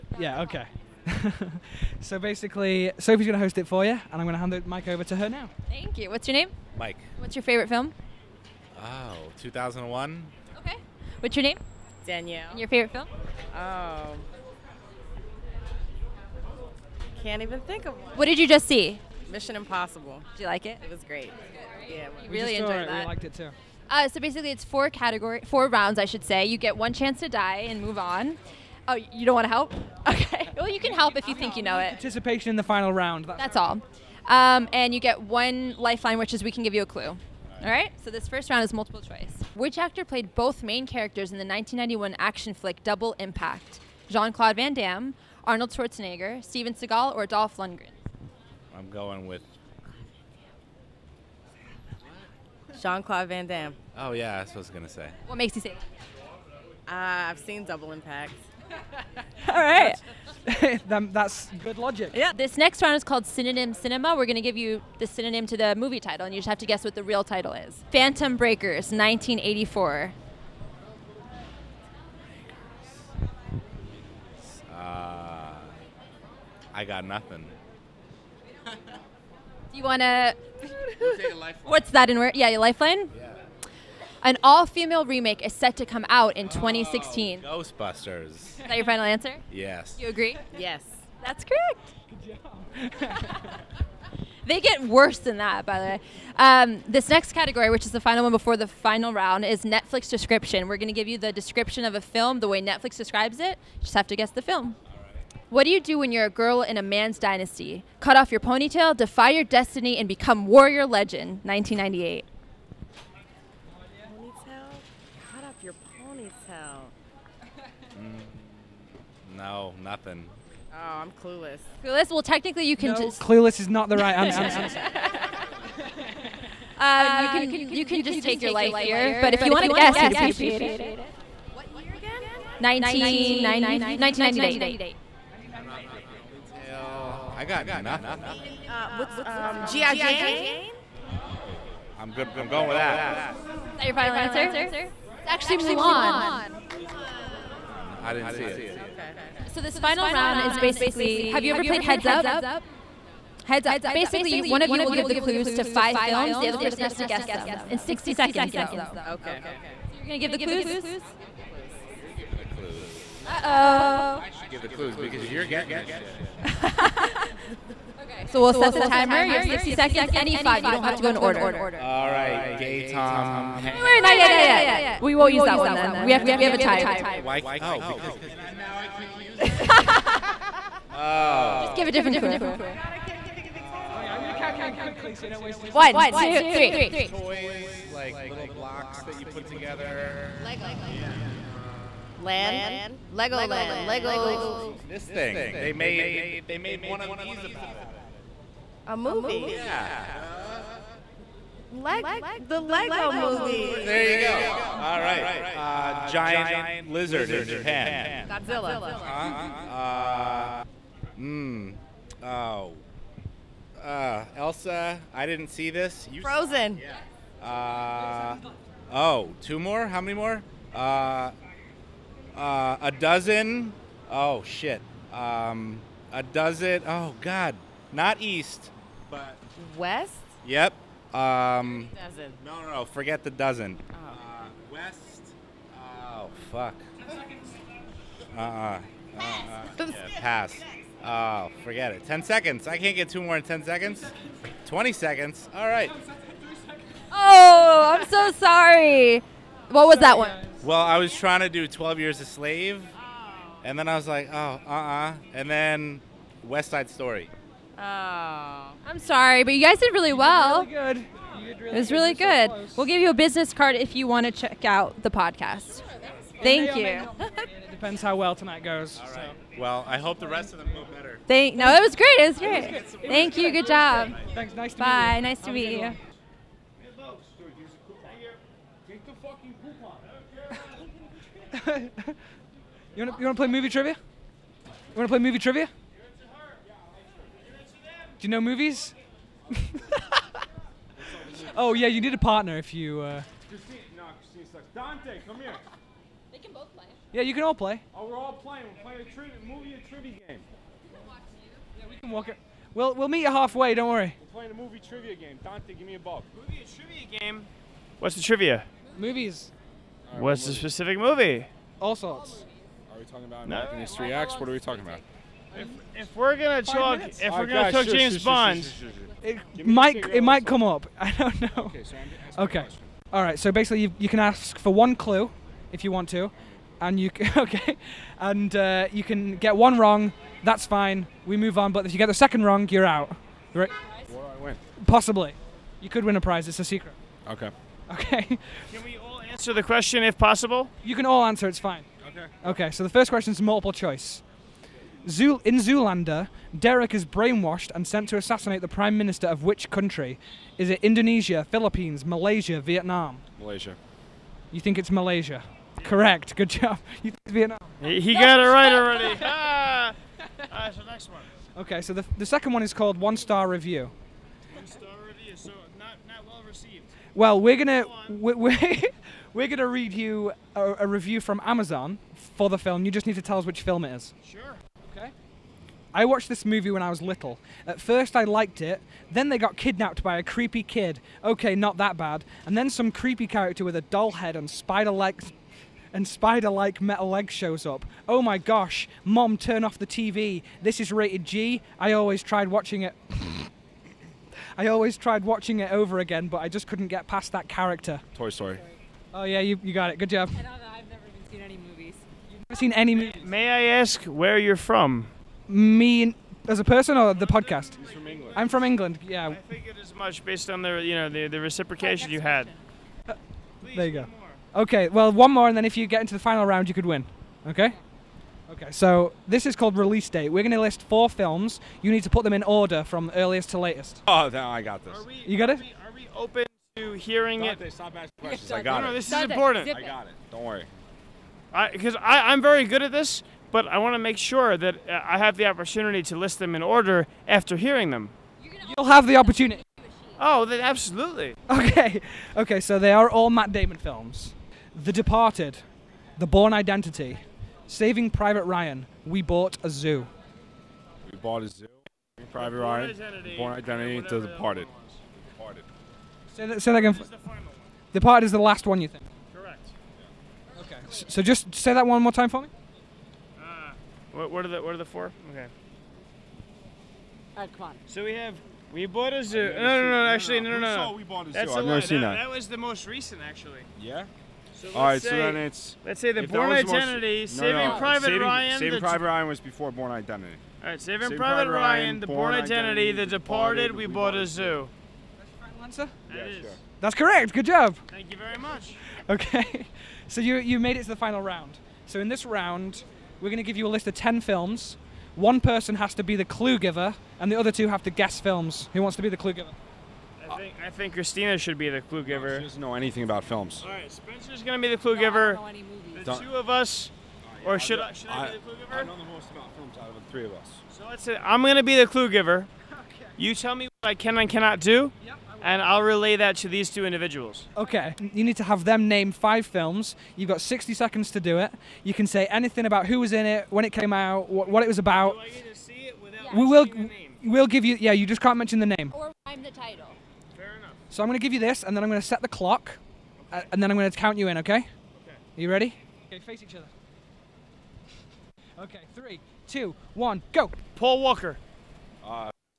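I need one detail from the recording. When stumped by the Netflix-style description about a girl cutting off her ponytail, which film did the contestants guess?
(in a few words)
GI Jane.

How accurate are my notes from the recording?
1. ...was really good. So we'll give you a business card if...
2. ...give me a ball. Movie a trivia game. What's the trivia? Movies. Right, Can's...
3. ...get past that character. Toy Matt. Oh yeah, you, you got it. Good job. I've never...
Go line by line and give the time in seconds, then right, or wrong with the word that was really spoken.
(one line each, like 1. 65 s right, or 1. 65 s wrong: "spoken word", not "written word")
1. 261 s right
2. 305 s wrong: "What", not "Can"
3. 396 s wrong: "Story", not "Matt".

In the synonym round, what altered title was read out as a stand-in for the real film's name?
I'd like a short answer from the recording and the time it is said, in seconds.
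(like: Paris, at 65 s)
Phantom Breakers, at 67 s.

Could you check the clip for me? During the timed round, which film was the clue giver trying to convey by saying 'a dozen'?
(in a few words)
12 Years a Slave.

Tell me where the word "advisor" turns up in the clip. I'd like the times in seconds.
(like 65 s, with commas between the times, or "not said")
not said.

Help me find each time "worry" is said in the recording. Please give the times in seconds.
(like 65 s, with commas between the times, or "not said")
303 s, 430 s.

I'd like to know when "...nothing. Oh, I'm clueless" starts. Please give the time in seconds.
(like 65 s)
119 s.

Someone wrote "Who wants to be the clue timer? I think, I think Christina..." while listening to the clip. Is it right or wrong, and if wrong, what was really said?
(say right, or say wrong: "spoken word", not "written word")
wrong: "giver", not "timer".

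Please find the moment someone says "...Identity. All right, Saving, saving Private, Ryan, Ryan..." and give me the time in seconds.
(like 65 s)
479 s.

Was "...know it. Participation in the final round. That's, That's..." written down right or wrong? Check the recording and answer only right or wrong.
right.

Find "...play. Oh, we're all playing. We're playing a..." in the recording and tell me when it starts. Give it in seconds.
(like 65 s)
297 s.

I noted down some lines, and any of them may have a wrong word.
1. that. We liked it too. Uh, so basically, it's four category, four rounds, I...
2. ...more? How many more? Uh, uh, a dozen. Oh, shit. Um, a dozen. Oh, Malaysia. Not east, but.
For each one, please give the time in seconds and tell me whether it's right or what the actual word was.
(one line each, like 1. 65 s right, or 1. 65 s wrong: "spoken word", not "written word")
1. 22 s right
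2. 219 s wrong: "God", not "Malaysia".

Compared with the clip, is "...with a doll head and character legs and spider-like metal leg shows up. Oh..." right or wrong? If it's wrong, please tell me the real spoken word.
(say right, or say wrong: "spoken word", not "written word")
wrong: "spider", not "character".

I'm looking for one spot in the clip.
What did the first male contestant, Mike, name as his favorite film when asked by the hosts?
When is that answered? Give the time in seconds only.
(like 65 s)
9 s.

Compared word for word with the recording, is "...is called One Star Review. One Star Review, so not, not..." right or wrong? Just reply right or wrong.
right.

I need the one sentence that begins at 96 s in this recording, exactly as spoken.
Um, this next category, which is the final one before the final round, is Netflix description.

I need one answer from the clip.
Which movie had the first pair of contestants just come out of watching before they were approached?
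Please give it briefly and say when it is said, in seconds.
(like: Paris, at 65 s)
Mission Impossible, at 19 s.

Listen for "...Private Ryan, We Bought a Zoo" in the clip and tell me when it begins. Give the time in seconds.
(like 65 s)
448 s.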